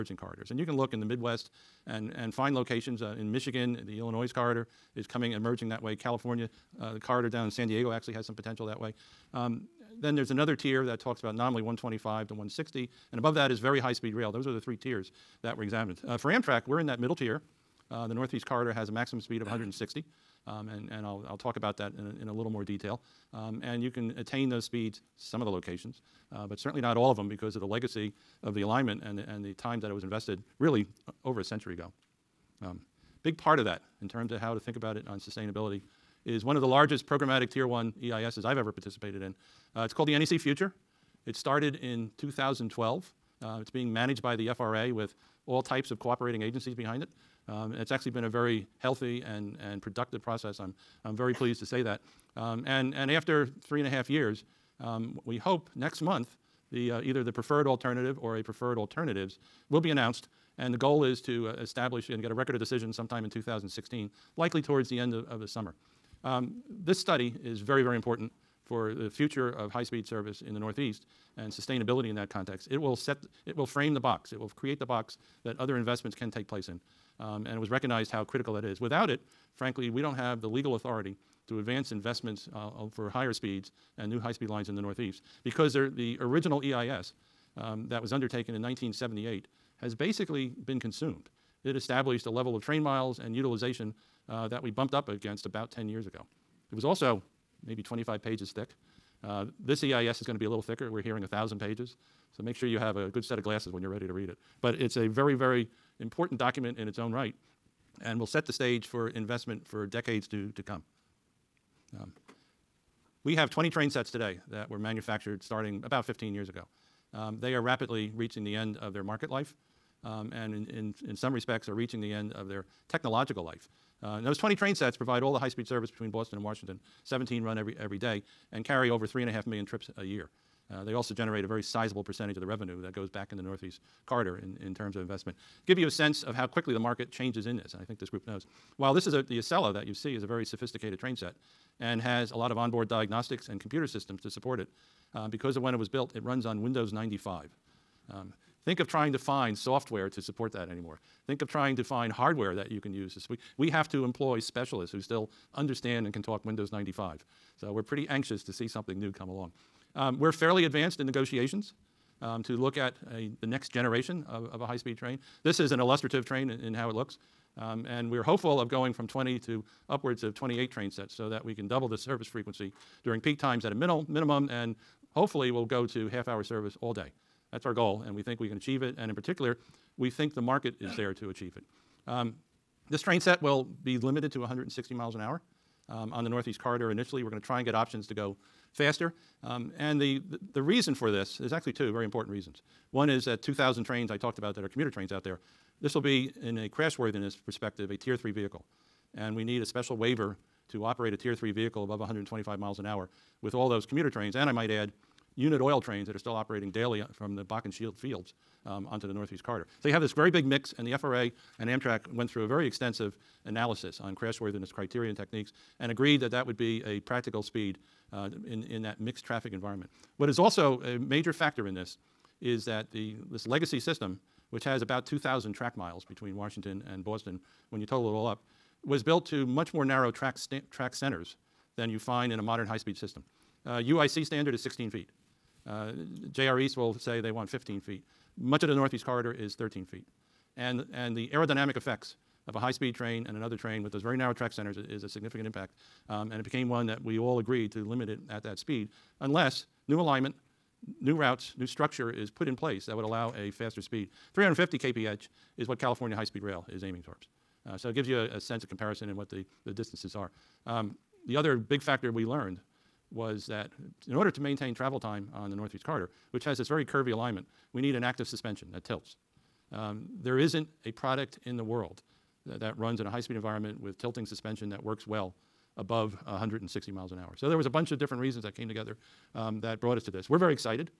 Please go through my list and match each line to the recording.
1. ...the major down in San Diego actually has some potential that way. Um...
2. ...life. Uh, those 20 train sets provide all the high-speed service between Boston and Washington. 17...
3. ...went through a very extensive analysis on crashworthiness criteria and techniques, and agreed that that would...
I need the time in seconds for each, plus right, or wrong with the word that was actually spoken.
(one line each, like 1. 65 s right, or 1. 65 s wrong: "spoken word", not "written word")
1. 6 s wrong: "corridor", not "major"
2. 123 s right
3. 212 s right.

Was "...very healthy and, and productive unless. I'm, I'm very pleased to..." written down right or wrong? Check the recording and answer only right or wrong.
wrong.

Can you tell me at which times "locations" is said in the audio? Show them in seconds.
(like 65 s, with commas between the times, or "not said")
2 s, 25 s.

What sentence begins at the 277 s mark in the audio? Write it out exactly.
So there was a bunch of different reasons that came together um, that brought us to this.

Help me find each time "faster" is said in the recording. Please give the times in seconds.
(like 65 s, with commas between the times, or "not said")
188 s, 253 s.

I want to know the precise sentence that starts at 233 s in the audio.
Uh, UIC standard is 16 feet.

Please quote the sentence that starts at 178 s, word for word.
And in particular, we think the market is there to achieve it.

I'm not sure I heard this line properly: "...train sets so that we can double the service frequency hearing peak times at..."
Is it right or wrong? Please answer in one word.
wrong.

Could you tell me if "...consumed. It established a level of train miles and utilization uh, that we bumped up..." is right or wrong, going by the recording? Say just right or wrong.
right.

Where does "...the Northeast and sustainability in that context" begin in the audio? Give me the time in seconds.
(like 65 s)
70 s.